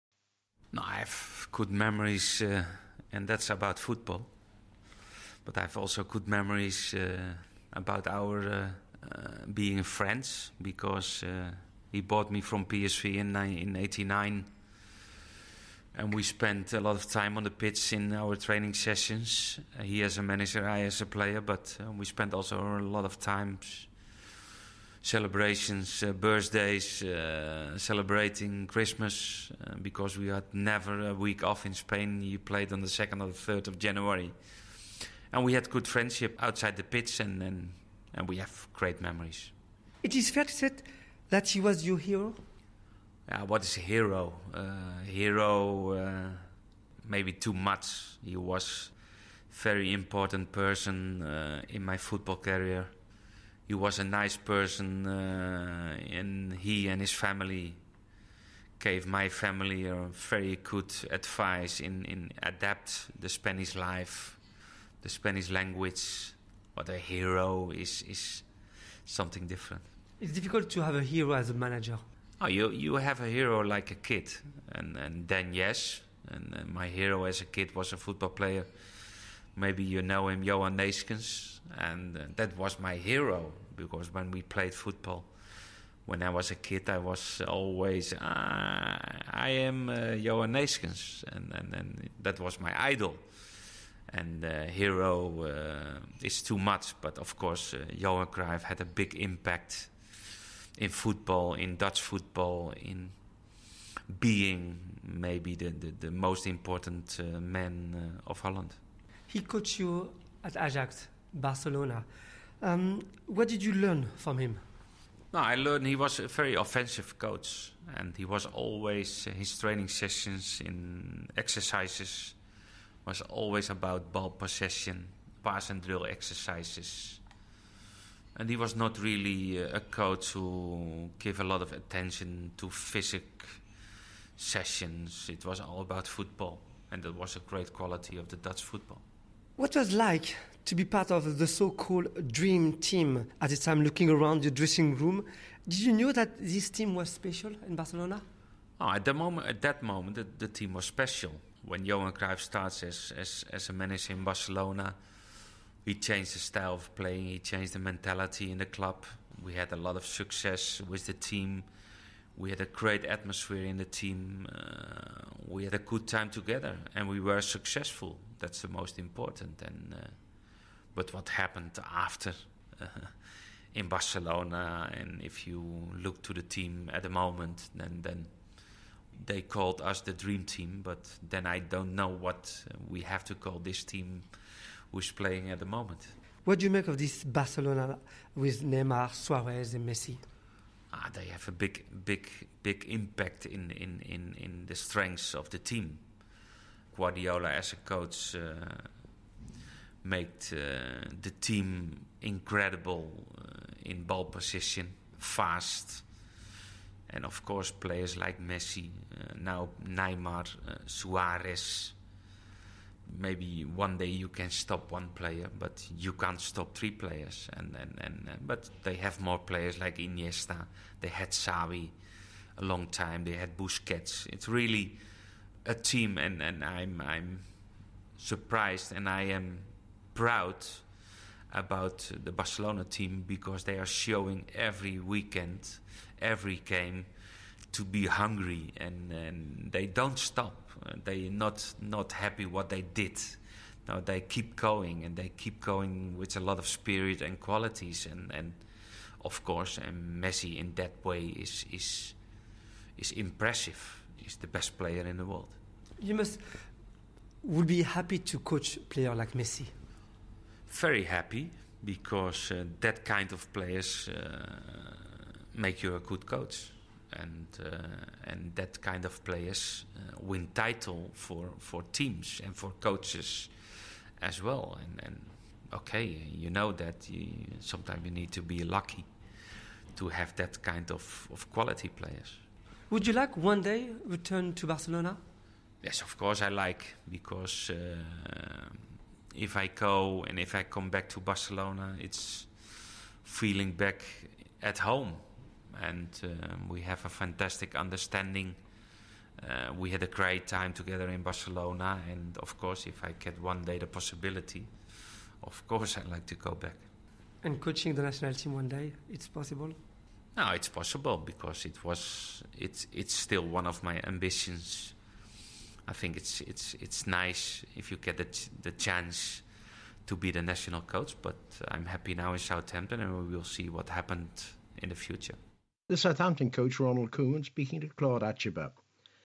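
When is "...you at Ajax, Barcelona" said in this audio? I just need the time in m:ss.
1:49.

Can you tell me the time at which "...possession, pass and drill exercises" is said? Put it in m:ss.
2:04.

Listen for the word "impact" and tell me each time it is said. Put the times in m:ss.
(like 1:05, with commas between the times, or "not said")
1:39, 3:12.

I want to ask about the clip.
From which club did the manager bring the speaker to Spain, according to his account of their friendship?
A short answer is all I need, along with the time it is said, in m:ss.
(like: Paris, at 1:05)
PSV, at 0:12.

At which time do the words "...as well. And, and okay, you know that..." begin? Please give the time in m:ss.
4:34.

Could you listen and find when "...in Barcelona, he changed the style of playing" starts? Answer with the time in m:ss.
2:34.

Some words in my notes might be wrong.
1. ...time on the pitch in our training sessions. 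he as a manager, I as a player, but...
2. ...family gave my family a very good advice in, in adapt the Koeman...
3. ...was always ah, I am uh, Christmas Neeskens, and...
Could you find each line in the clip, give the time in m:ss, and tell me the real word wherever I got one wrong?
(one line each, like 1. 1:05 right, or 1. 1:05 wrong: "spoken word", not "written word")
1. 0:17 right
2. 0:57 wrong: "Spanish", not "Koeman"
3. 1:26 wrong: "Johan", not "Christmas".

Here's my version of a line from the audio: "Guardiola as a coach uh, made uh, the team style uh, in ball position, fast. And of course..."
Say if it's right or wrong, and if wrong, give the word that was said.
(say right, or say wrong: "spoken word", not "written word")
wrong: "incredible", not "style".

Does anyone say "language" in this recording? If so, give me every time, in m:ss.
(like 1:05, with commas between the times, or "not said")
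1:05.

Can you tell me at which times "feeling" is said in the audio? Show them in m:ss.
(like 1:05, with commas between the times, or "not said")
4:53.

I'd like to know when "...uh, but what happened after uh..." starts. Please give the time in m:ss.
2:49.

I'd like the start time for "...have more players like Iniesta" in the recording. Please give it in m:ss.
3:38.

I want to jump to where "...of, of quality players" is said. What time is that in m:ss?
4:40.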